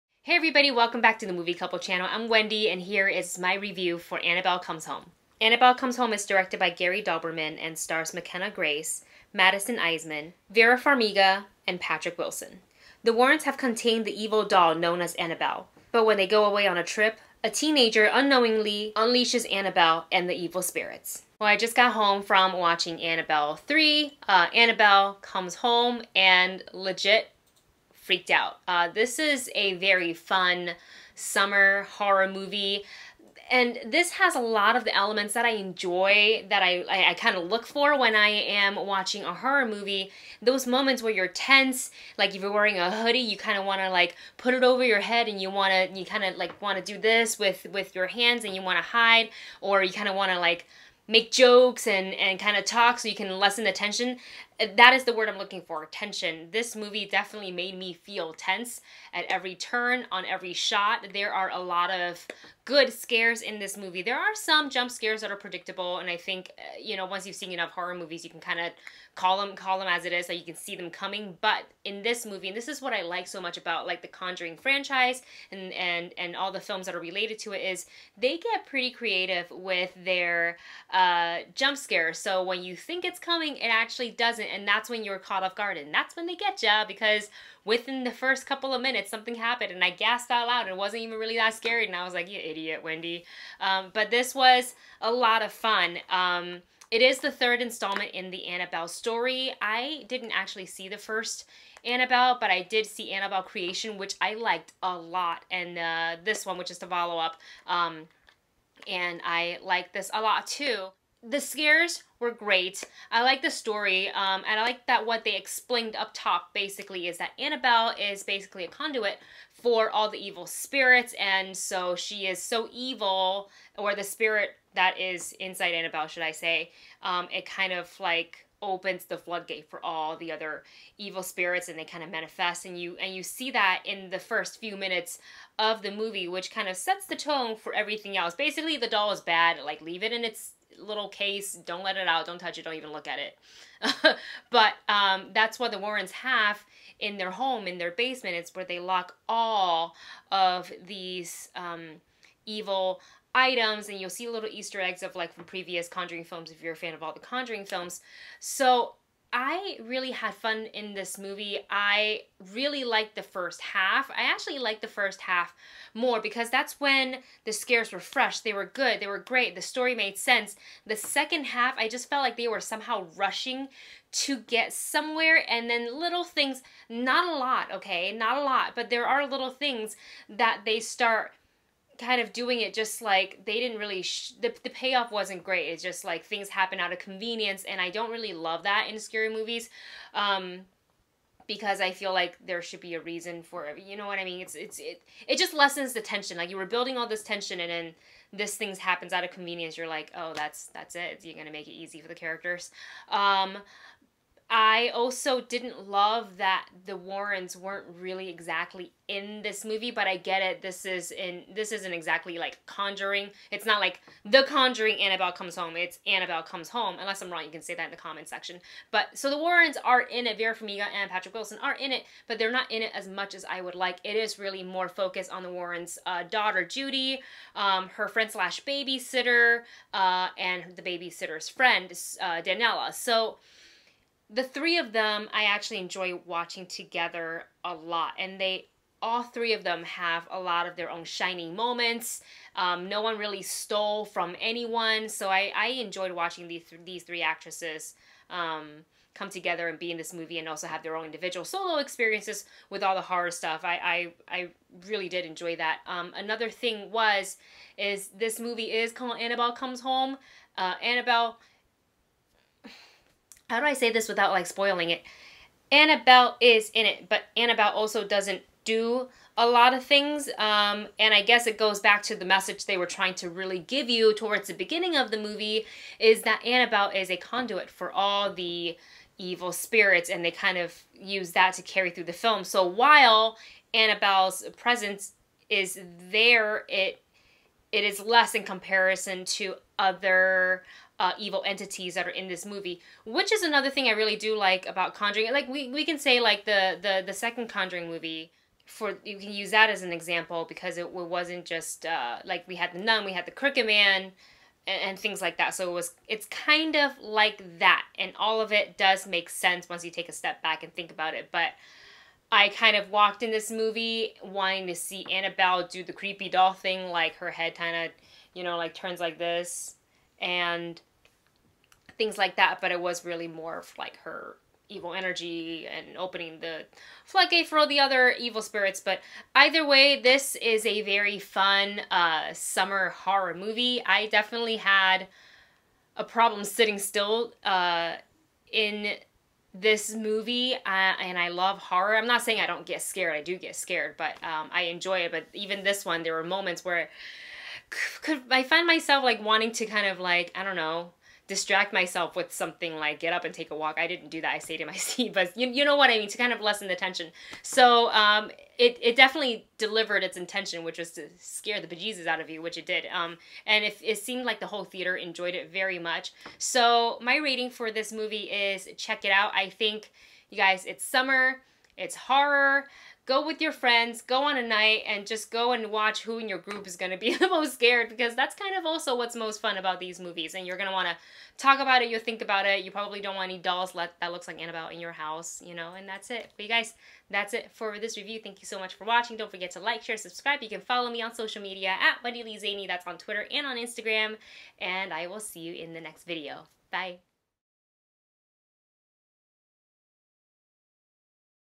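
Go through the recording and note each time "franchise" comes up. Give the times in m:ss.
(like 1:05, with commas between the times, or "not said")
1:14.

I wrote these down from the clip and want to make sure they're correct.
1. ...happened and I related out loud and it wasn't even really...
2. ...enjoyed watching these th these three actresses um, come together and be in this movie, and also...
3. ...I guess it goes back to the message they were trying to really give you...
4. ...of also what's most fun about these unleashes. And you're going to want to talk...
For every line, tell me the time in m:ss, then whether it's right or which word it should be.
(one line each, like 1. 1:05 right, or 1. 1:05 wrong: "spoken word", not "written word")
1. 1:29 wrong: "gasped", not "related"
2. 4:05 right
3. 4:31 right
4. 6:18 wrong: "movies", not "unleashes".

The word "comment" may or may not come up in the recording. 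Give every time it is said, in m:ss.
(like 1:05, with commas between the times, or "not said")
3:37.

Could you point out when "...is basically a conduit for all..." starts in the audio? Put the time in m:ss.
1:57.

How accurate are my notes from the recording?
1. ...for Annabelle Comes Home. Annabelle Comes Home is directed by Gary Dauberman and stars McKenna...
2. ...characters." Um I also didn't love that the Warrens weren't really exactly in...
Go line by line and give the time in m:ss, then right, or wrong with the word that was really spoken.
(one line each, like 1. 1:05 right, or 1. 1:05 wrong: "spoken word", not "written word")
1. 0:03 right
2. 3:22 right.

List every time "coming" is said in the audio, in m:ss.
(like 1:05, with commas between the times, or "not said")
1:10, 1:23.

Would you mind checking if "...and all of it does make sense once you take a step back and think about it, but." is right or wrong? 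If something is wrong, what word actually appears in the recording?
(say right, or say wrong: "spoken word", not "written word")
right.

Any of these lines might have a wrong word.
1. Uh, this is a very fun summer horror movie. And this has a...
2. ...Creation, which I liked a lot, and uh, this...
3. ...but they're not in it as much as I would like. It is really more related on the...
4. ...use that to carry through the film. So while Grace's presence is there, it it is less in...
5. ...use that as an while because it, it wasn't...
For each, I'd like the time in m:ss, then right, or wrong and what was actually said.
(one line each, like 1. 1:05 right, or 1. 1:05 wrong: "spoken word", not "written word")
1. 0:28 right
2. 1:43 right
3. 3:42 wrong: "focused", not "related"
4. 4:40 wrong: "Annabelle", not "Grace"
5. 4:59 wrong: "example", not "while".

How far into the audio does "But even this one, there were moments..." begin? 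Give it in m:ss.
5:45.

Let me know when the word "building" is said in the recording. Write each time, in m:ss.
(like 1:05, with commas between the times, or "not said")
3:16.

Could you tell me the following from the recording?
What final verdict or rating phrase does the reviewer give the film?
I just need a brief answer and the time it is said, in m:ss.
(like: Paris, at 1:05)
check it out, at 6:08.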